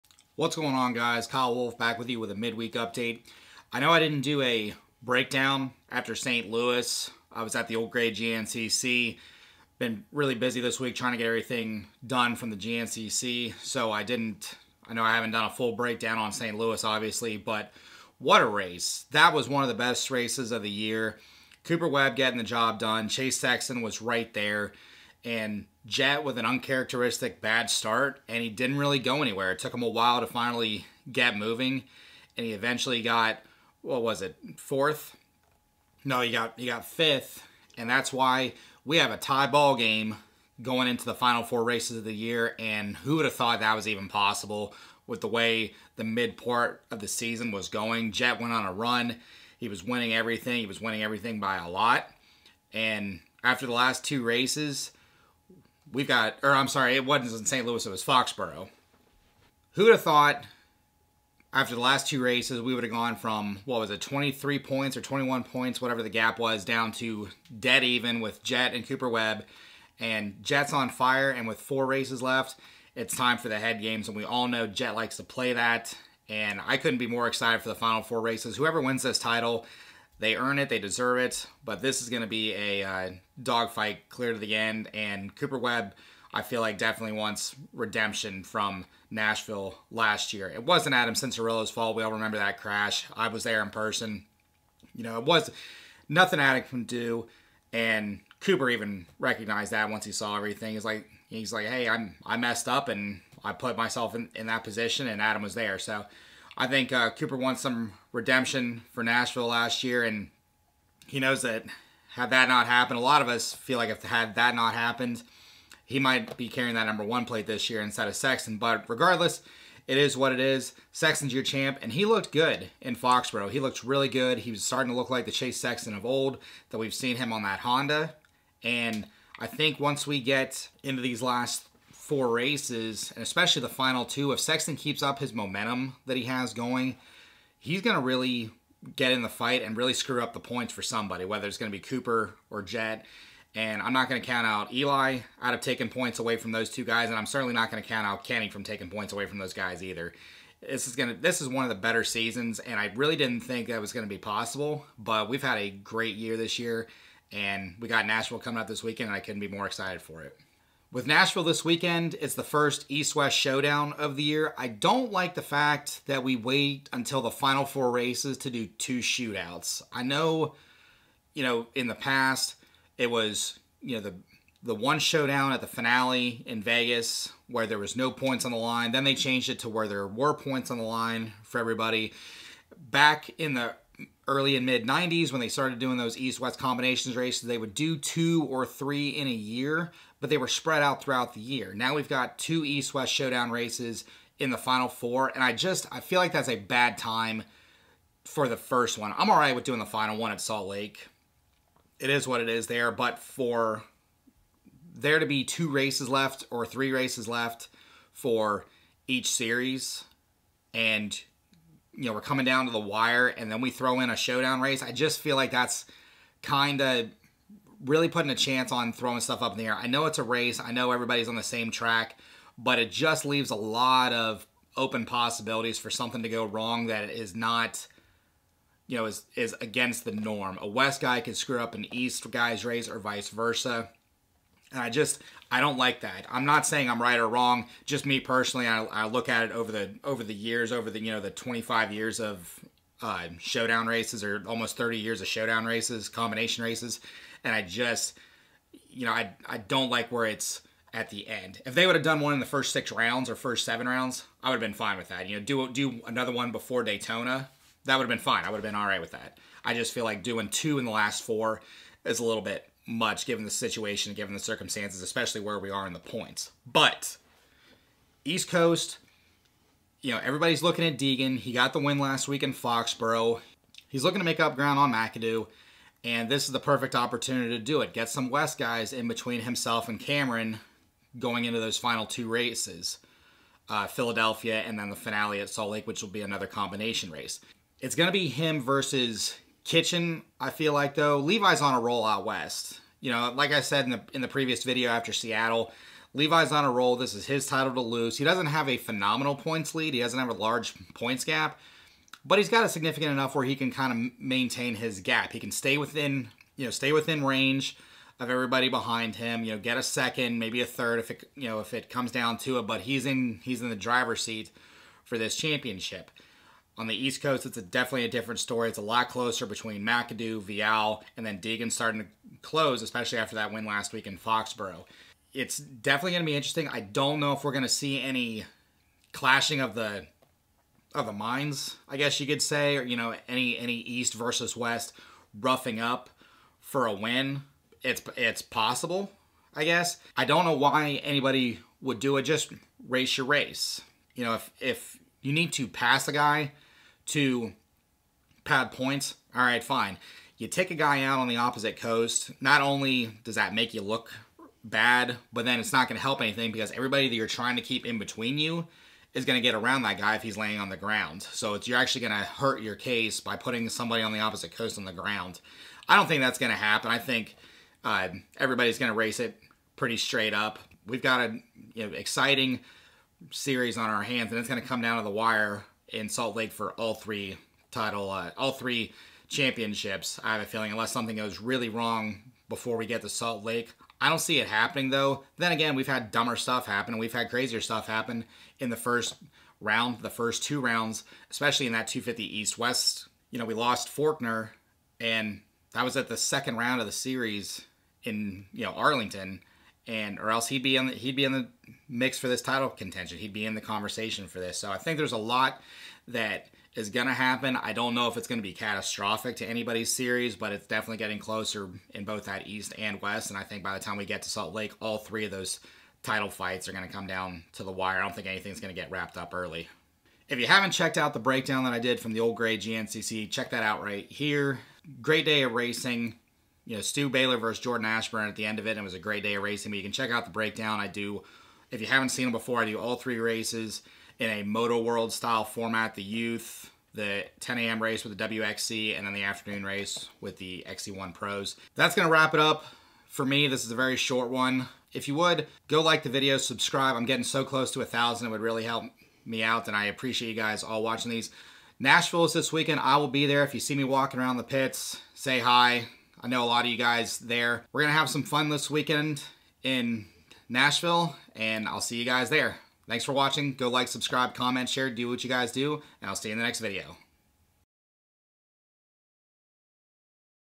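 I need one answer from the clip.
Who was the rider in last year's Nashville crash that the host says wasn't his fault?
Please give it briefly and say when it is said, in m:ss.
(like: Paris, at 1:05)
Adam Cianciarulo, at 1:30.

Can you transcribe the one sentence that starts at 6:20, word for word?
I have a feeling, unless something goes really wrong before we get to Salt Lake, I don't see it happening though.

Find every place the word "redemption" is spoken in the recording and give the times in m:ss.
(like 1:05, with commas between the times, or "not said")
1:27, 1:48.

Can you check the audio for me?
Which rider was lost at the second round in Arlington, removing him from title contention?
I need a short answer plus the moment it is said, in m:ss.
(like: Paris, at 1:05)
Forkner, at 6:33.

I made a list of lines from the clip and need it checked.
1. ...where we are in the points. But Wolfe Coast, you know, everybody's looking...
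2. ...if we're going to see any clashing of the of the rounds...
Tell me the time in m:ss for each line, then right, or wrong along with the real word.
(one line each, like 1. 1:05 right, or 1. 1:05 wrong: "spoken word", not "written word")
1. 4:25 wrong: "East", not "Wolfe"
2. 5:27 wrong: "minds", not "rounds".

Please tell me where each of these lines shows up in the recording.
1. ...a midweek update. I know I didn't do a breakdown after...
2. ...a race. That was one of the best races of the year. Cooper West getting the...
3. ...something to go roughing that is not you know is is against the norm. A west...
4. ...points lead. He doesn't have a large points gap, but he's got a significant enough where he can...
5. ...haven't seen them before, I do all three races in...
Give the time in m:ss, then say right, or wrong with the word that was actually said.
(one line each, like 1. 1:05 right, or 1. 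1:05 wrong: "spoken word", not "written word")
1. 0:02 right
2. 0:18 wrong: "Webb", not "West"
3. 3:45 wrong: "wrong", not "roughing"
4. 4:59 right
5. 7:11 right.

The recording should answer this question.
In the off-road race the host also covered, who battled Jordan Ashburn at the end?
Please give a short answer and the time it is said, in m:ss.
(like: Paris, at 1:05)
Stu Baylor, at 7:06.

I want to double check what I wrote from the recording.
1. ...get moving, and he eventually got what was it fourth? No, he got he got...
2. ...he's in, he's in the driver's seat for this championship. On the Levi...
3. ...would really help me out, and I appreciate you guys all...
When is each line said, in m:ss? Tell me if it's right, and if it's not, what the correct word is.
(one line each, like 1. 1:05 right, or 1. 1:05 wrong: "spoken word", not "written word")
1. 0:31 right
2. 5:12 wrong: "East", not "Levi"
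3. 7:28 right.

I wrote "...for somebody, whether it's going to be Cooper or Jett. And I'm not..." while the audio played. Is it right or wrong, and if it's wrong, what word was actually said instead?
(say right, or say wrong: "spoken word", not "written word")
right.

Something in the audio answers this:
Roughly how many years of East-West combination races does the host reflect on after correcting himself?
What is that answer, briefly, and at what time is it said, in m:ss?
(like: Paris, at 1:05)
Almost 30, at 4:04.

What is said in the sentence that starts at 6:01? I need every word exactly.
So you're actually going to hurt your case by putting somebody on the opposite coast on the ground.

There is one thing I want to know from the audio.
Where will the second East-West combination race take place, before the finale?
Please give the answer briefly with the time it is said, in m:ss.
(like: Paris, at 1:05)
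Philadelphia, at 4:43.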